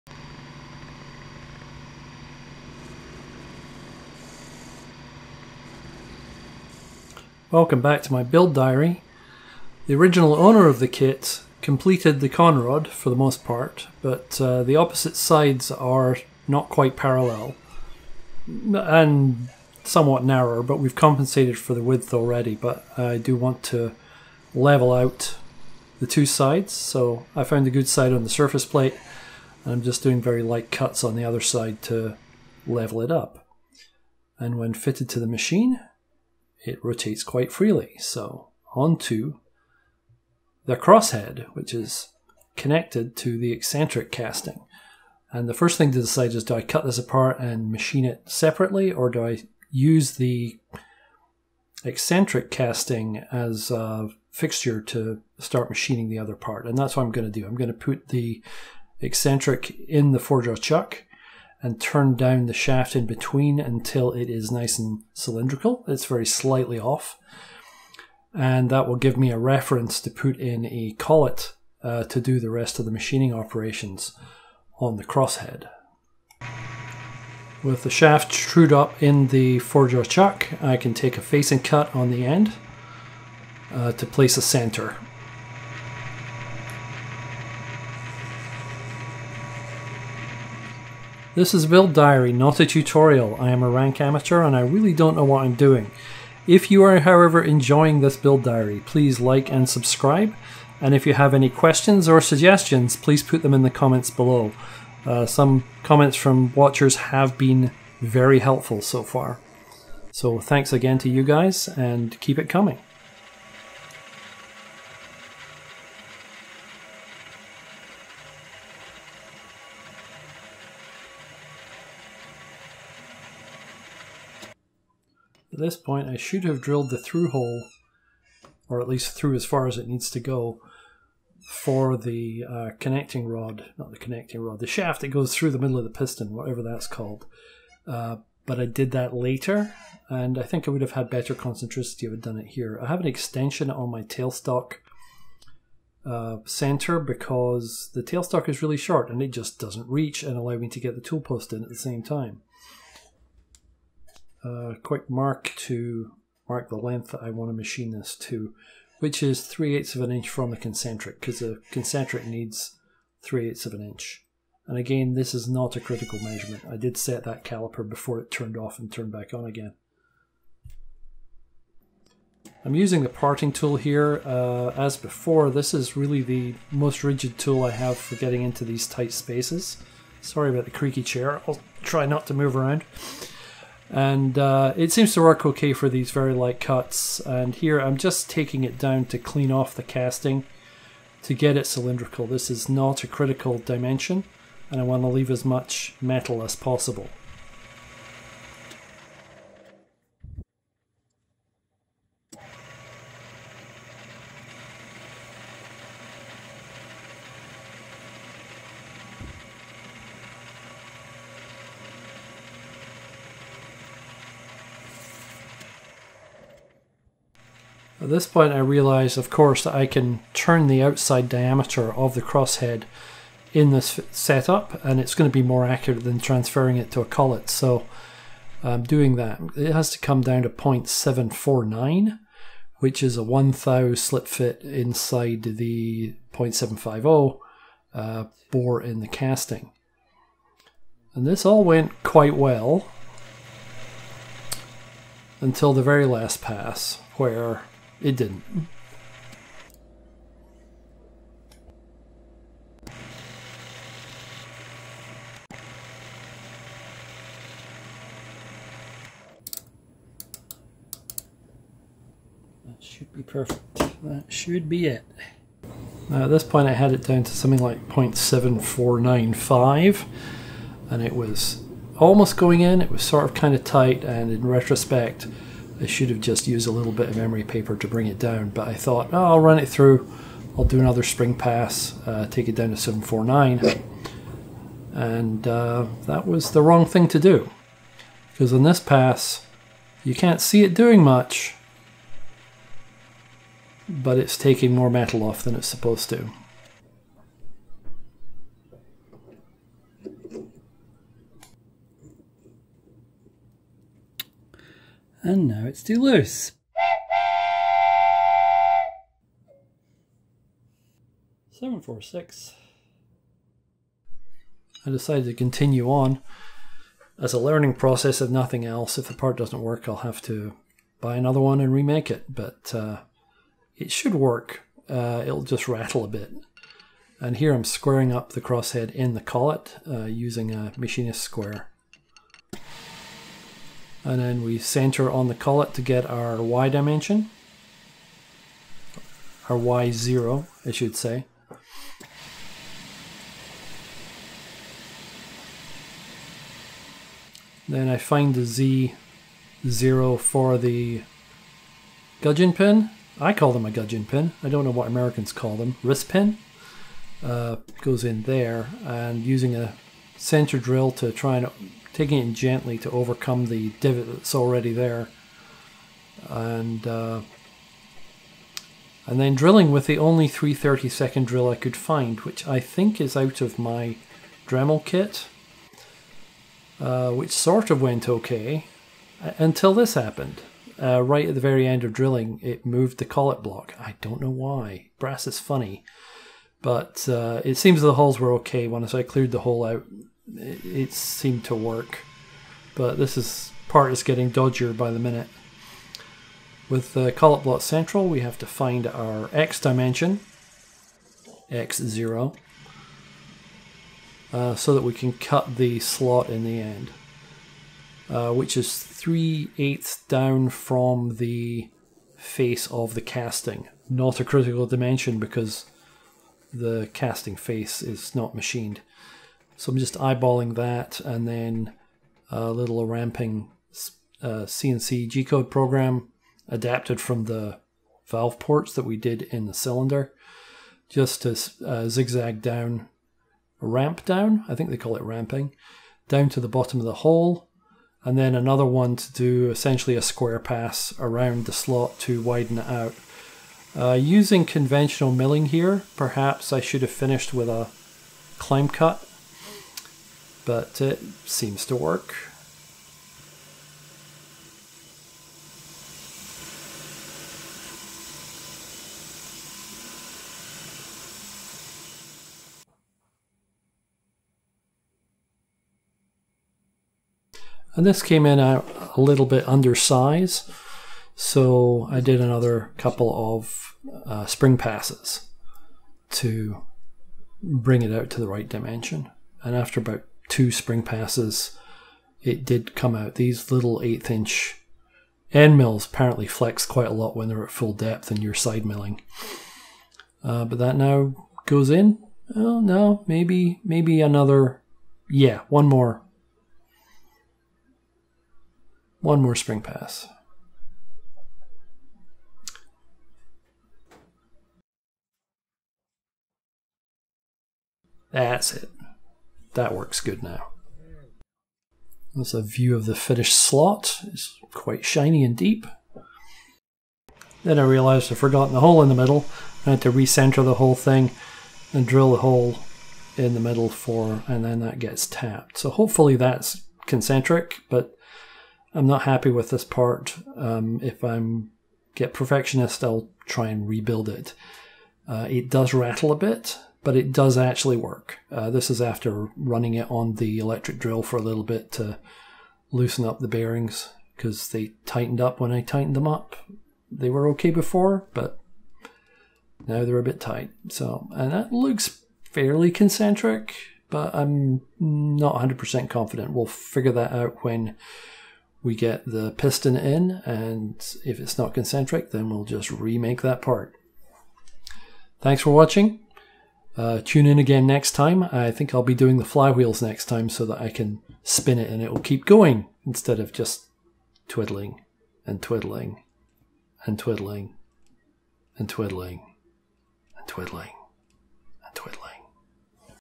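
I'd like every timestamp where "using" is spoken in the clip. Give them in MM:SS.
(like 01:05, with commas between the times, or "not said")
02:52, 05:30, 05:59, 07:23.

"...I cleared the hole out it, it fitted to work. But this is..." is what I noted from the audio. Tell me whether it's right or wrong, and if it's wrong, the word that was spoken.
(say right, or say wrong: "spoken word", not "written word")
wrong: "seemed", not "fitted".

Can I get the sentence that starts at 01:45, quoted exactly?
Uh, some comments from watchers have been very helpful so far.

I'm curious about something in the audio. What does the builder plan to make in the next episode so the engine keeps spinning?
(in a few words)
flywheels.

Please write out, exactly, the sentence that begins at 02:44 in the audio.
And again, this is not a critical measurement.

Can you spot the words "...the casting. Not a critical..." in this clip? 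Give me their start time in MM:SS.
06:52.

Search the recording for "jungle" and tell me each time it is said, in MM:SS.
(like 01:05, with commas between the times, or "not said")
not said.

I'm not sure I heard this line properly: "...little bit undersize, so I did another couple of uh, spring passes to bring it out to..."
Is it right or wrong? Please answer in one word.
right.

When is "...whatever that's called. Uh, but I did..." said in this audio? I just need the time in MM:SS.
02:16.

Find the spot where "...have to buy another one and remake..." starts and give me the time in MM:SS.
05:19.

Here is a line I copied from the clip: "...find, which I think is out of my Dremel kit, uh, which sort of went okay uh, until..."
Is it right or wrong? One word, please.
right.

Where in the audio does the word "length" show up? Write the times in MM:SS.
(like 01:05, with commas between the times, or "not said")
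02:36.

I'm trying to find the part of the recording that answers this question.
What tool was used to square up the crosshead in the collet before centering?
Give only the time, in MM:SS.
05:30.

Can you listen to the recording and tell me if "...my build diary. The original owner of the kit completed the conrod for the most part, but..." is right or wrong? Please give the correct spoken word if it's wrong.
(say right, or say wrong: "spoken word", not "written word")
right.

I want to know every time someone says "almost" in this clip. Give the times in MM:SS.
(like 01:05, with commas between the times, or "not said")
04:31.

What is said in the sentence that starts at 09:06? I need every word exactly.
They were okay before, but now they're a bit tight.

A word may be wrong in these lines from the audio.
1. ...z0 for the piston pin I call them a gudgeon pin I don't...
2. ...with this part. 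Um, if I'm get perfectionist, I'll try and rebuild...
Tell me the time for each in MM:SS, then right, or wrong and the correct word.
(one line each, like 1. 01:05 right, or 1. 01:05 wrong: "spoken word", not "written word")
1. 05:49 wrong: "gudgeon", not "piston"
2. 08:49 right.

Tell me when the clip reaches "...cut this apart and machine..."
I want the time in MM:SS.
00:46.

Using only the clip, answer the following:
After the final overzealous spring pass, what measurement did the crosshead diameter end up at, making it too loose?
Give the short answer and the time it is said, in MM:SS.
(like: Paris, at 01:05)
0.746, at 05:11.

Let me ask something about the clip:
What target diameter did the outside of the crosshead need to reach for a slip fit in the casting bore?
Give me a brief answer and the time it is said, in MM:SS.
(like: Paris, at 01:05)
0.749, at 03:50.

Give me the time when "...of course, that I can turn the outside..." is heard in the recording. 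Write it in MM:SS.
03:39.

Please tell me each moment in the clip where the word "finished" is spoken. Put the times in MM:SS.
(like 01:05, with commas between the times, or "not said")
07:26, 08:32.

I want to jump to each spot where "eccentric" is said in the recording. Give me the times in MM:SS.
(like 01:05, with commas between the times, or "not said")
00:43, 00:51, 00:58.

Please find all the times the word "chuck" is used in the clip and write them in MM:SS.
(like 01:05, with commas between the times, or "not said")
01:00, 01:20.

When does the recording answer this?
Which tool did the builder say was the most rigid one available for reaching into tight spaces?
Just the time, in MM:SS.
02:53.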